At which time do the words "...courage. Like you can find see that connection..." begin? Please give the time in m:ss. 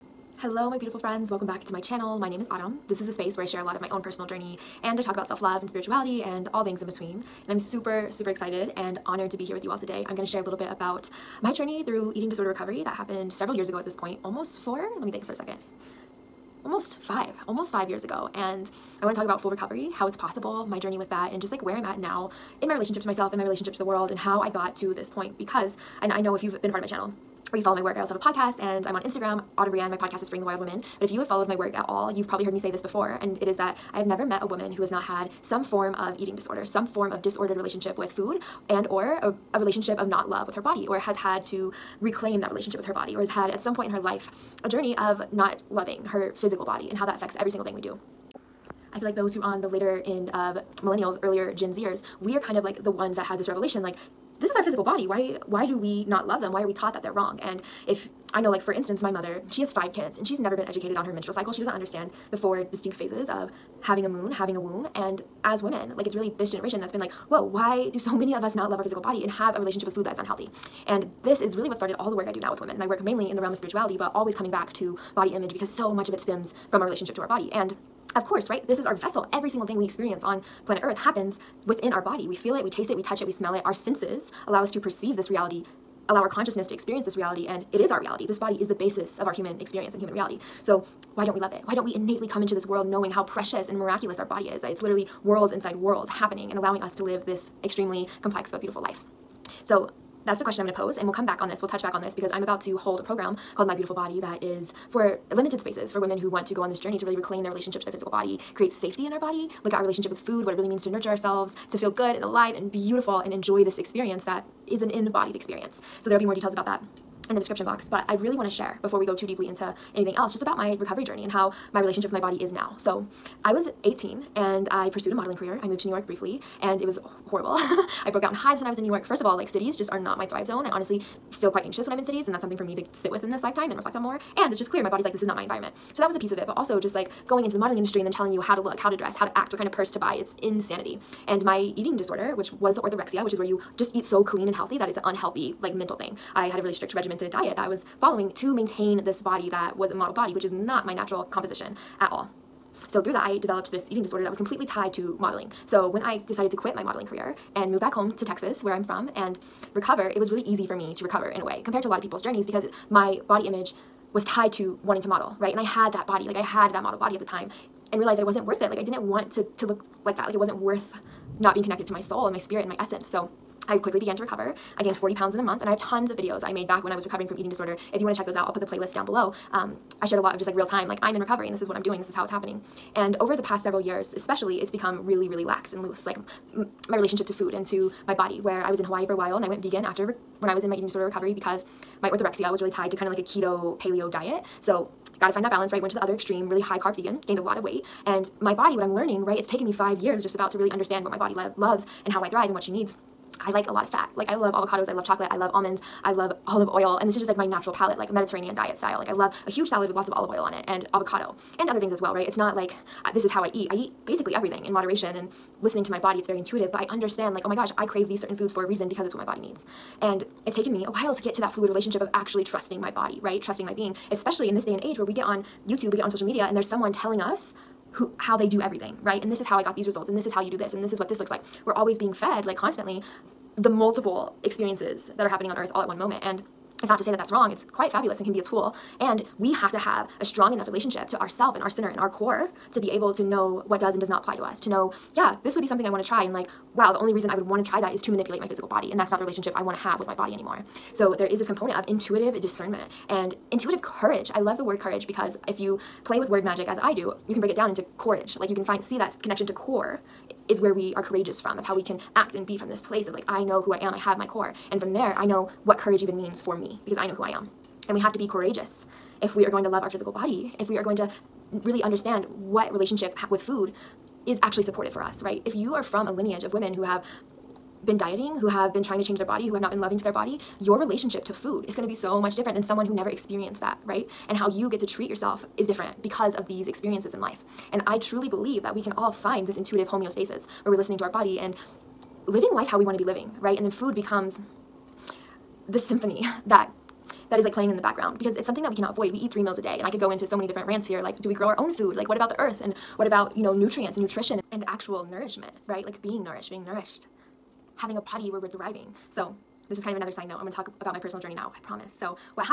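4:17.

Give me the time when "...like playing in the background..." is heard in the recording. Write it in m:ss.
4:57.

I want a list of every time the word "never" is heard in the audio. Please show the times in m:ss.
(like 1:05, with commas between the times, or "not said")
0:34, 1:00, 4:42.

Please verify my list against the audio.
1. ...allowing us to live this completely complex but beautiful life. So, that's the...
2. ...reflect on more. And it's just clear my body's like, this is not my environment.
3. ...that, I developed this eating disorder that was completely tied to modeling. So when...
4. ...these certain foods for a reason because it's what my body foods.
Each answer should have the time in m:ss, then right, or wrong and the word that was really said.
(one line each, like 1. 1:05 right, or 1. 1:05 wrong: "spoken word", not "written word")
1. 1:36 wrong: "extremely", not "completely"
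2. 2:13 right
3. 2:33 right
4. 3:38 wrong: "needs", not "foods".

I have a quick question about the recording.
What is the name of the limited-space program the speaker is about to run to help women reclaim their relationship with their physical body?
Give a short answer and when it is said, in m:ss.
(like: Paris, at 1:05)
My Beautiful Body, at 1:43.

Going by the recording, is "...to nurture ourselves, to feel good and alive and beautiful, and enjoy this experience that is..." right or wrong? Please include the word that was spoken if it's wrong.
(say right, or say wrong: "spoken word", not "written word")
right.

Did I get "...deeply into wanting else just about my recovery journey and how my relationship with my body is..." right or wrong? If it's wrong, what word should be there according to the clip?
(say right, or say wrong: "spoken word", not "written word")
wrong: "anything", not "wanting".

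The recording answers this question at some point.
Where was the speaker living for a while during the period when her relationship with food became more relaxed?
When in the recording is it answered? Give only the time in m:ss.
3:08.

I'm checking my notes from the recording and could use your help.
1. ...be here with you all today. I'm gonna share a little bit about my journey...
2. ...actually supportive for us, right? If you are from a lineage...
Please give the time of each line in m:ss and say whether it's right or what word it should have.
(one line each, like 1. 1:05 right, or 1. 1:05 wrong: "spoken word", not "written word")
1. 0:09 right
2. 4:34 right.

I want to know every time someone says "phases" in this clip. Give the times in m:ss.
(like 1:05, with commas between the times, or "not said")
1:02.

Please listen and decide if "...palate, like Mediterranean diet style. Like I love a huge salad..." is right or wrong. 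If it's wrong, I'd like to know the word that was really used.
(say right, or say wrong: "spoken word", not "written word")
right.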